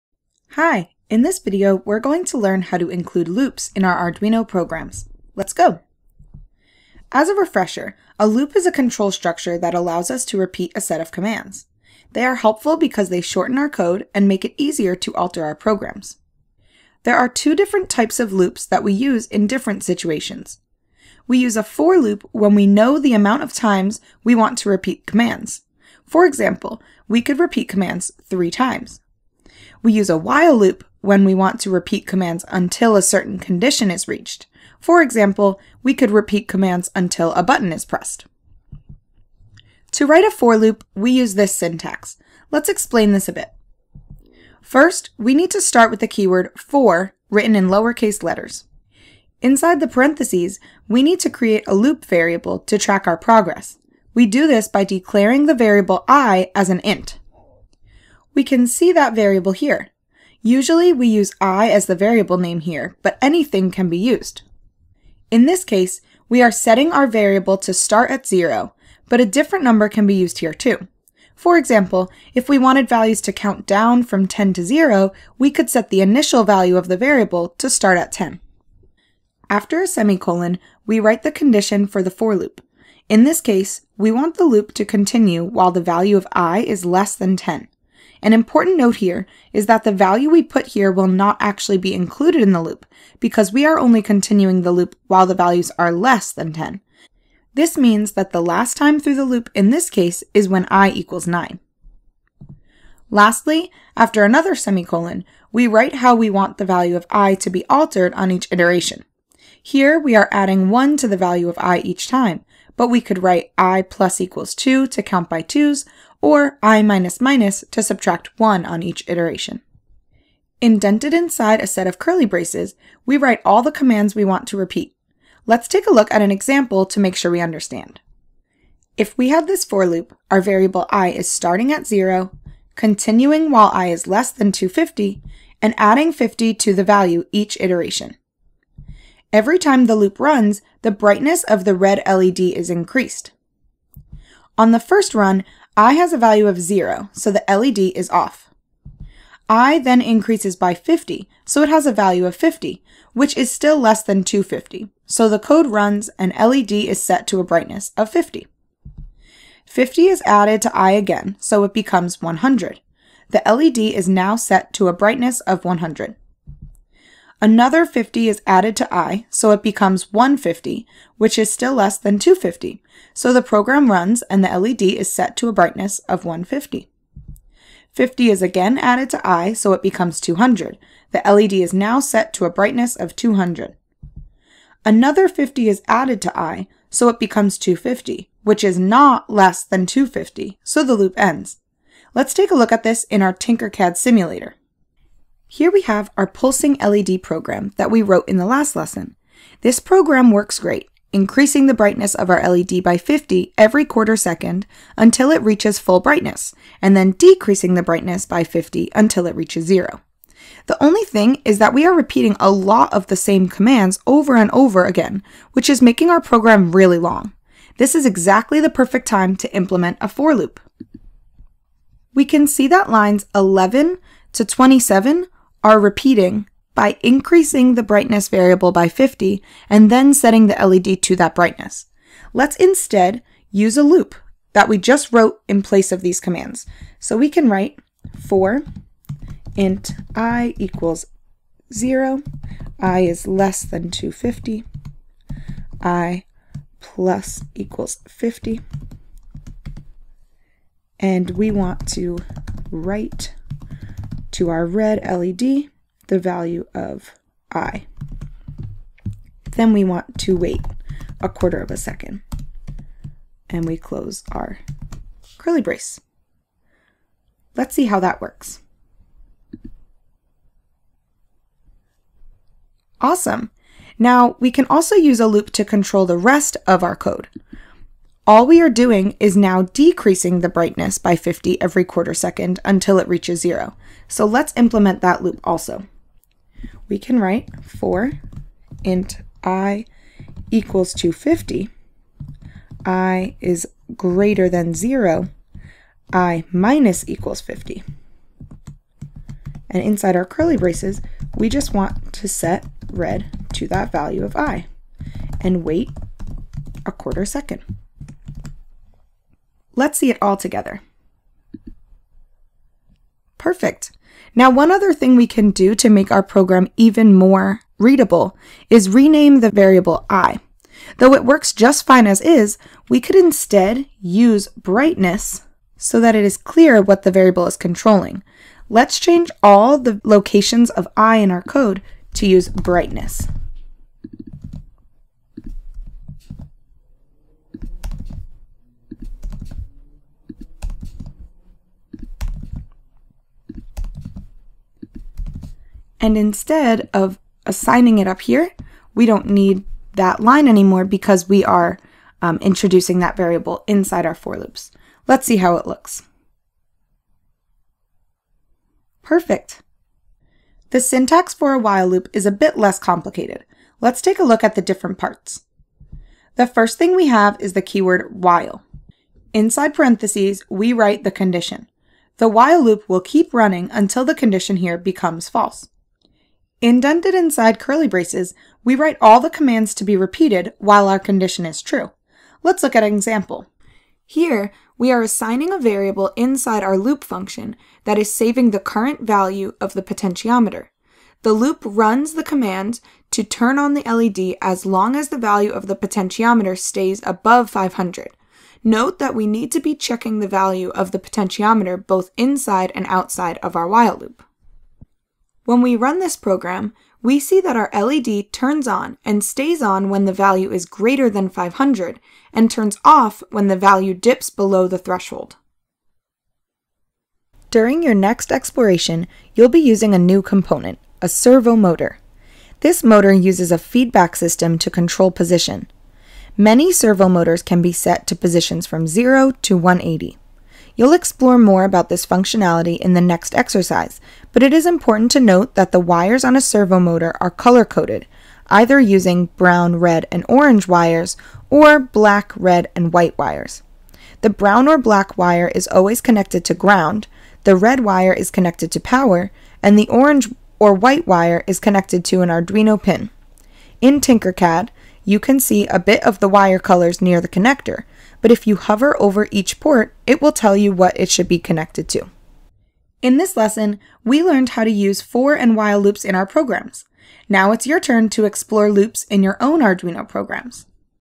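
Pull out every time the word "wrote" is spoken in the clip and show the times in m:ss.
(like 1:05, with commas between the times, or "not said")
3:18, 3:55.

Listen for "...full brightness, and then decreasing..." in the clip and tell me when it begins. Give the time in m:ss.
3:25.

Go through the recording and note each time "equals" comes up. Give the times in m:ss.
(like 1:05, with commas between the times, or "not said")
1:40, 1:54, 4:00, 4:07, 4:50, 4:57.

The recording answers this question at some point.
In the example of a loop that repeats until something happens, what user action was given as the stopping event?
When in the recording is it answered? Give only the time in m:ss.
0:37.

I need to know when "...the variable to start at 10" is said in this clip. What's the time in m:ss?
1:16.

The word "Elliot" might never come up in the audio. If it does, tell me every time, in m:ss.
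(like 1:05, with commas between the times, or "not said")
not said.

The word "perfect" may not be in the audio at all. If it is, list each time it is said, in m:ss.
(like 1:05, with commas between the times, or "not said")
3:38, 5:13, 5:59.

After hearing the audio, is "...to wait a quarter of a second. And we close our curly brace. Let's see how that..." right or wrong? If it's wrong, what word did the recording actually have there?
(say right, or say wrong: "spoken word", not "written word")
right.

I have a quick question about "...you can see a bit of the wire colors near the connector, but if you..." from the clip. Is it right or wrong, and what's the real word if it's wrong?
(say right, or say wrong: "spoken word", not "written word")
right.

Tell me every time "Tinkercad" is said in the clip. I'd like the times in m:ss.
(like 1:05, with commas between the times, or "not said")
3:13, 7:34.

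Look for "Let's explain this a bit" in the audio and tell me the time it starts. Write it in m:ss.
0:42.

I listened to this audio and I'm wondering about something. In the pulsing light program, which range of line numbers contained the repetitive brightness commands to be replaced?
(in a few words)
11 to 27.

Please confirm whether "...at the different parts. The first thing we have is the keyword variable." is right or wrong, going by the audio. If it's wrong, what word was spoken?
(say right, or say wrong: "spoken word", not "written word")
wrong: "while", not "variable".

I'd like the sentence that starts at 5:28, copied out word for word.
Let's change all the locations of i in our code to use brightness.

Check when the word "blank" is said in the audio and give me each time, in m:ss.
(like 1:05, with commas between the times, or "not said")
not said.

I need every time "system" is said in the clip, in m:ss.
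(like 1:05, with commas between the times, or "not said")
7:04.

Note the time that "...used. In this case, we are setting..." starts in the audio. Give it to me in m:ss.
1:03.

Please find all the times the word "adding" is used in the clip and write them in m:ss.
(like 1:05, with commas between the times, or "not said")
1:50, 2:15.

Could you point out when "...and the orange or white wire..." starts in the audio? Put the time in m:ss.
7:29.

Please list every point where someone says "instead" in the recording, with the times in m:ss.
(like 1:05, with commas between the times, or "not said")
3:52, 5:23, 5:46.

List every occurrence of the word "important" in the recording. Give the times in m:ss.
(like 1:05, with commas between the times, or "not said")
1:28, 7:14.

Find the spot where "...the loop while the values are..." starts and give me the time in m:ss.
1:34.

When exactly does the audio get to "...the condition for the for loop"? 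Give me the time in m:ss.
1:21.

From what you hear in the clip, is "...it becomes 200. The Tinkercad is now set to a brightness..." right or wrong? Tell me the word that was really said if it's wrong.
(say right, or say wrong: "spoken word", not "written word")
wrong: "LED", not "Tinkercad".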